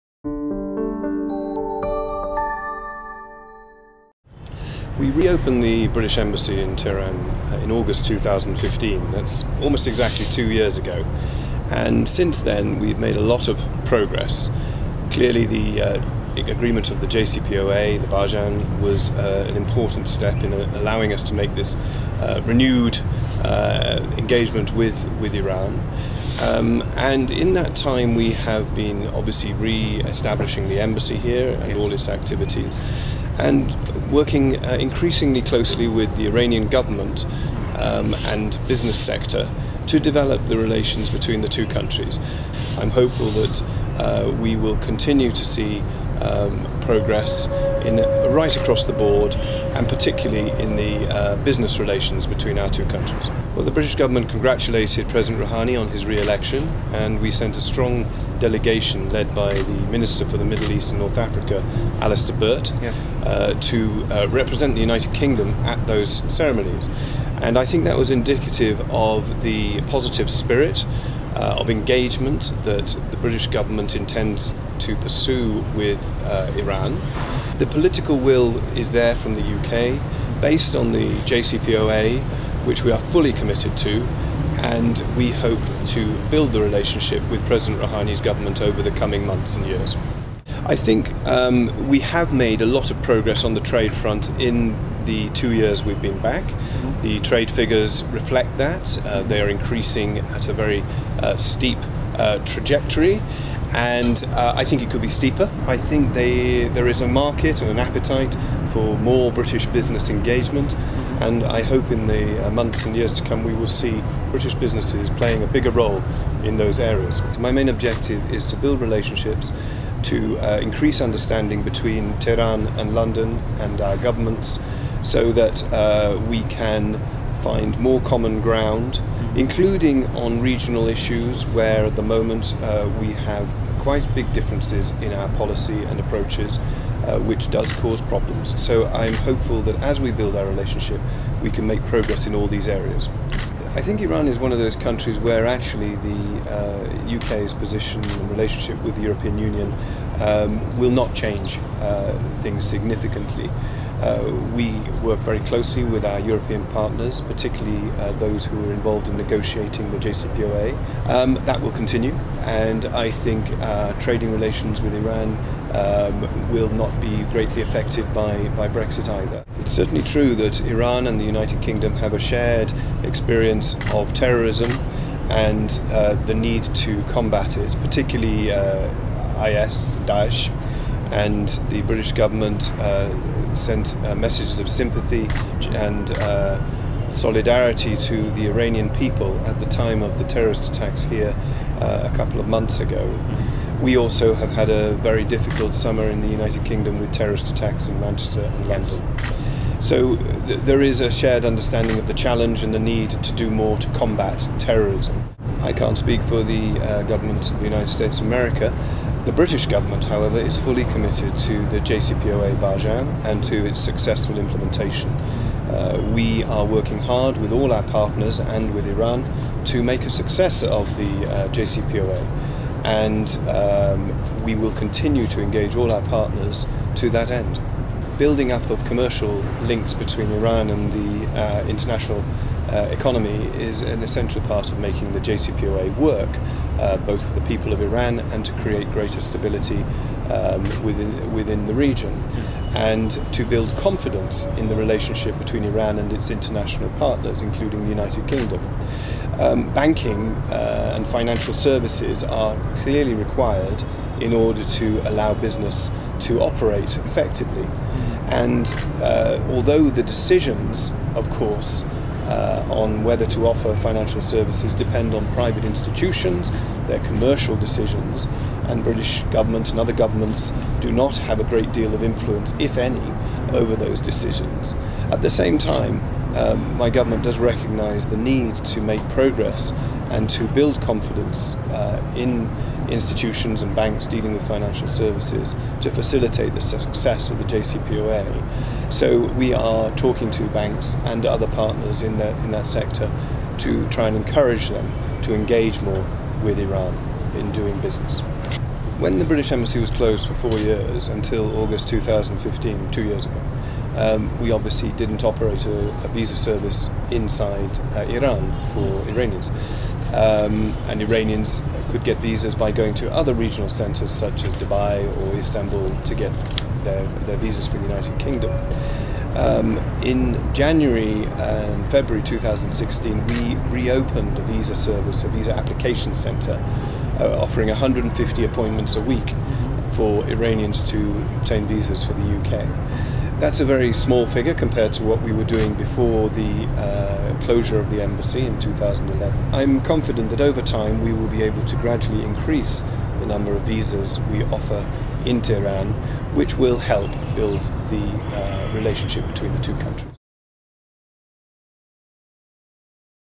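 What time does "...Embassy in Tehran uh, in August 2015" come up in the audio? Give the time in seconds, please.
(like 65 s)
6 s.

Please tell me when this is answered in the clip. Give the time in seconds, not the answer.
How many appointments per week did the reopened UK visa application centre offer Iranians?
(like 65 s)
327 s.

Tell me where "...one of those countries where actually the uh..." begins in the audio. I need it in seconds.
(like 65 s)
144 s.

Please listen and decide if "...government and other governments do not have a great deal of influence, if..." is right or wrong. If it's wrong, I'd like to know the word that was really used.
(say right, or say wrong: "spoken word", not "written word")
right.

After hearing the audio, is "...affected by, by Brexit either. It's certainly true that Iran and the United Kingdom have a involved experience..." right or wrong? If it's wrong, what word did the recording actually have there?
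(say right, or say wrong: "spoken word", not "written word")
wrong: "shared", not "involved".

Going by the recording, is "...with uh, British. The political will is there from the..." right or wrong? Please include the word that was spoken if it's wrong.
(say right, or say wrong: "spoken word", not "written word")
wrong: "Iran", not "British".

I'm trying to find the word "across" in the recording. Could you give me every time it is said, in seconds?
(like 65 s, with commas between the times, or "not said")
48 s.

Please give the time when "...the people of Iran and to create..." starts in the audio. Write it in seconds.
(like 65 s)
237 s.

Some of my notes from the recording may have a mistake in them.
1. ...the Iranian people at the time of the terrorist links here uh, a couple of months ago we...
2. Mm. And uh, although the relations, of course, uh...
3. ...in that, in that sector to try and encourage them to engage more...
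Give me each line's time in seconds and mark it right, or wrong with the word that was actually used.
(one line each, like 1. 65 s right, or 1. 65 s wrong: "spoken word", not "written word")
1. 188 s wrong: "attacks", not "links"
2. 257 s wrong: "decisions", not "relations"
3. 292 s right.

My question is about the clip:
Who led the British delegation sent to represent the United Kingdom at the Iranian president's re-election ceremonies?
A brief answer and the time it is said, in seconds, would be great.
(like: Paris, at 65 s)
Alistair Burt, at 61 s.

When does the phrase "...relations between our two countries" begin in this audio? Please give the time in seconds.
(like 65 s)
51 s.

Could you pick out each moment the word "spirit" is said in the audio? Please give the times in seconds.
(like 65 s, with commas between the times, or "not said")
70 s.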